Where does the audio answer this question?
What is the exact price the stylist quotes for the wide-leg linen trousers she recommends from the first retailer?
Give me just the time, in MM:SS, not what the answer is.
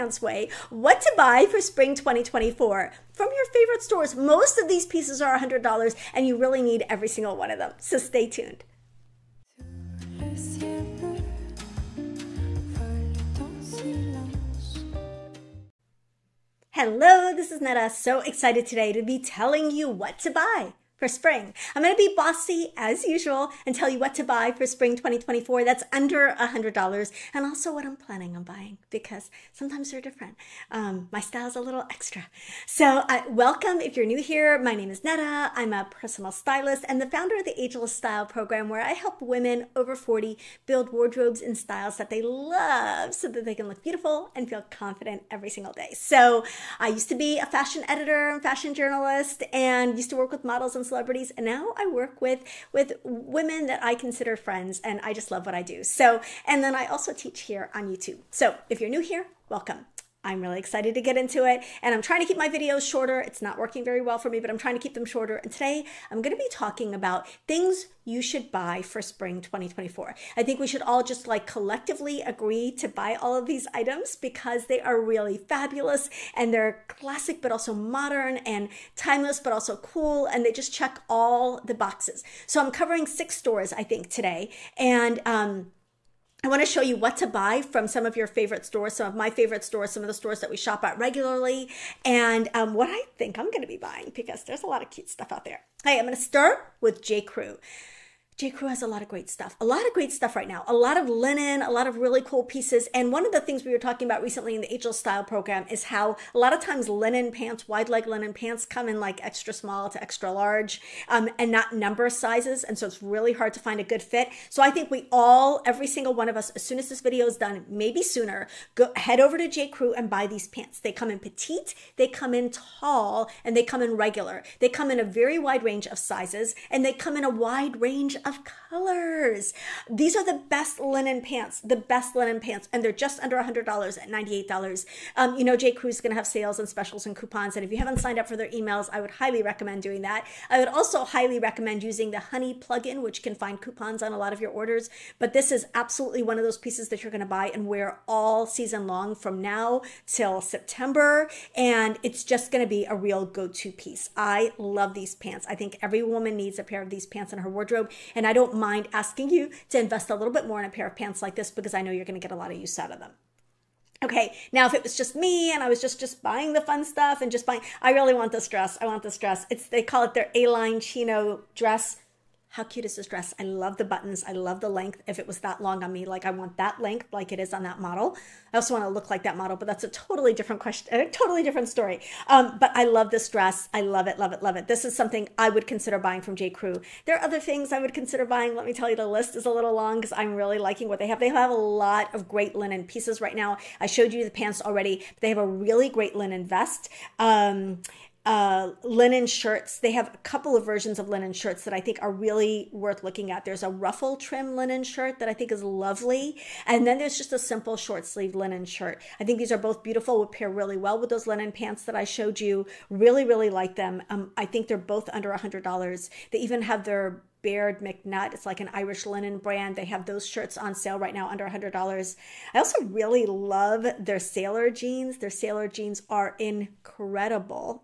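02:14.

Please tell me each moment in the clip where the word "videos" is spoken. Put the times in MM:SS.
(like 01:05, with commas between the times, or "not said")
01:02, 01:57.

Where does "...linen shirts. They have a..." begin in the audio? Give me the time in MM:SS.
03:18.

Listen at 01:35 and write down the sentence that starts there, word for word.
Hey, I'm going to start with J.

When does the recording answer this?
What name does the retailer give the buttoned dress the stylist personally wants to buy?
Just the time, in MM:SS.
02:50.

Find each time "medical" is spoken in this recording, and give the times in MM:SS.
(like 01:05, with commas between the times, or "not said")
not said.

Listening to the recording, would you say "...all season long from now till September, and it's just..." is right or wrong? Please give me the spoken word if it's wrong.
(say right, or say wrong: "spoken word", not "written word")
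right.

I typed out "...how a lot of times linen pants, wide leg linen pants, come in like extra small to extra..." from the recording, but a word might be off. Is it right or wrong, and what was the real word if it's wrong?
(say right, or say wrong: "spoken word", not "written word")
right.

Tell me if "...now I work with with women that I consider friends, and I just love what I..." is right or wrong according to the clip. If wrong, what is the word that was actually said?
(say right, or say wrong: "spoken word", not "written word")
right.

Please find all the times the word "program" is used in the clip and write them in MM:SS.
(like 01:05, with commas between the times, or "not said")
00:38, 01:45.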